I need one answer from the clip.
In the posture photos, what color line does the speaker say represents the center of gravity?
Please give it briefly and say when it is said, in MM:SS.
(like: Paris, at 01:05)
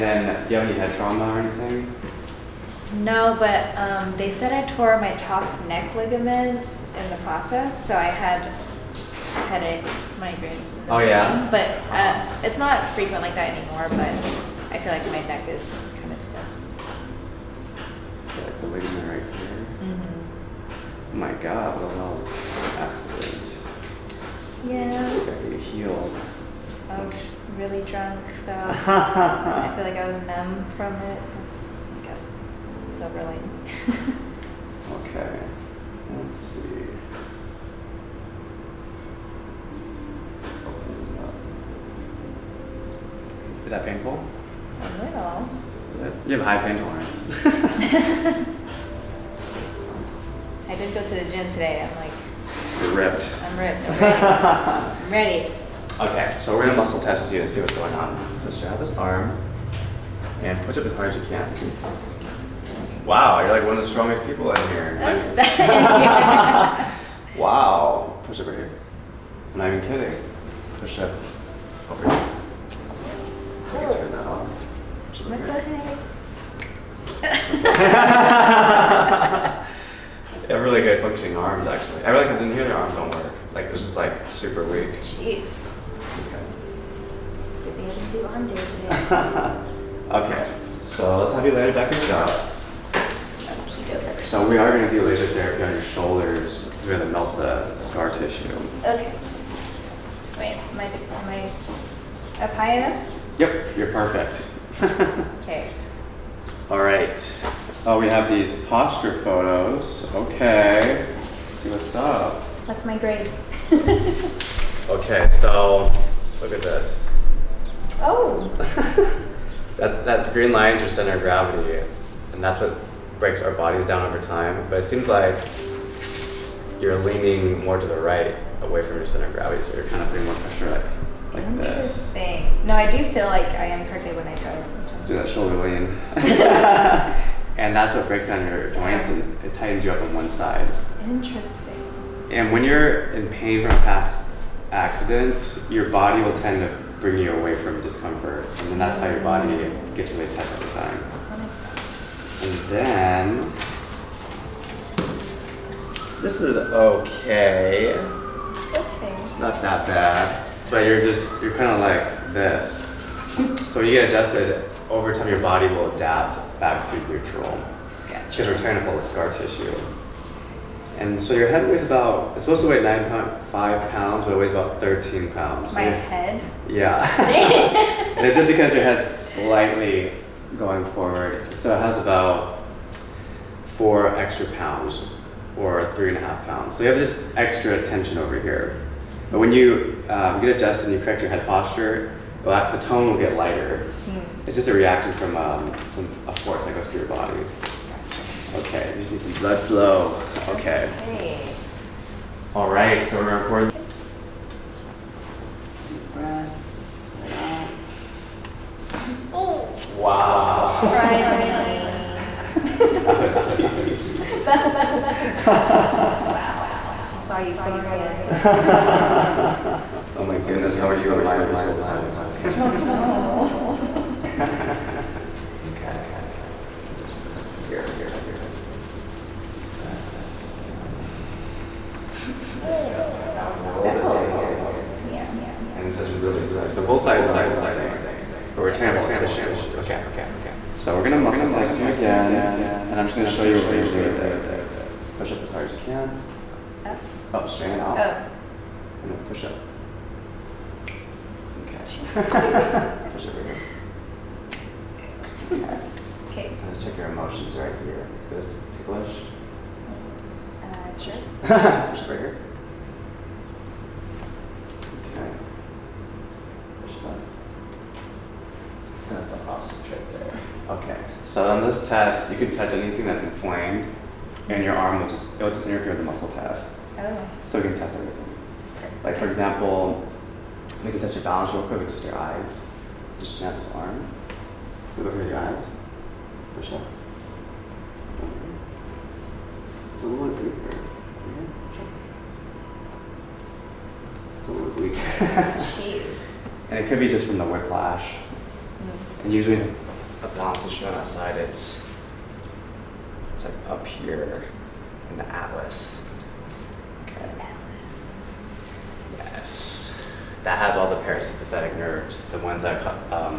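green, at 02:00.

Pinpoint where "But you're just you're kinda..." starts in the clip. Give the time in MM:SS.
02:40.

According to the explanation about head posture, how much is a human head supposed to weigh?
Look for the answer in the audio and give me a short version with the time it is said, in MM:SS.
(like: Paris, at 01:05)
9.5 pounds, at 02:52.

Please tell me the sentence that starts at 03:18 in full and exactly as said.
Okay, you just need some blood flow.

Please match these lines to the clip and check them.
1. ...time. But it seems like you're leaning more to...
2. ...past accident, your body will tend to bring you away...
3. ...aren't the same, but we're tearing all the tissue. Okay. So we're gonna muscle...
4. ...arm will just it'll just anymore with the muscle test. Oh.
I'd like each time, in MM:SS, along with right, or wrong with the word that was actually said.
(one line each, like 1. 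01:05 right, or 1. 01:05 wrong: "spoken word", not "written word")
1. 02:04 right
2. 02:23 right
3. 03:57 right
4. 04:34 wrong: "interfere", not "anymore".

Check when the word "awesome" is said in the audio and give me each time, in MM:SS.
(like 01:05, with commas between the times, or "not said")
04:29.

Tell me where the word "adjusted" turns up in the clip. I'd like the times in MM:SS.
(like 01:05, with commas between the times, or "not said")
02:44, 03:10.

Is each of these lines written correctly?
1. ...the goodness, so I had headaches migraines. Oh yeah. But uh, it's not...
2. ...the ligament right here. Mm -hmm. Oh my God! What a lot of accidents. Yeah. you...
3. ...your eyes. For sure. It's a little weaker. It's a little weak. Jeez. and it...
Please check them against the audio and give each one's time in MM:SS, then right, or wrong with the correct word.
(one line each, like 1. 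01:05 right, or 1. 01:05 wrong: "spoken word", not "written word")
1. 00:07 wrong: "process", not "goodness"
2. 00:18 right
3. 04:45 right.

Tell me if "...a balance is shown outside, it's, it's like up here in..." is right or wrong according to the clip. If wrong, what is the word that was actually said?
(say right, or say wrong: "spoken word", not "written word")
right.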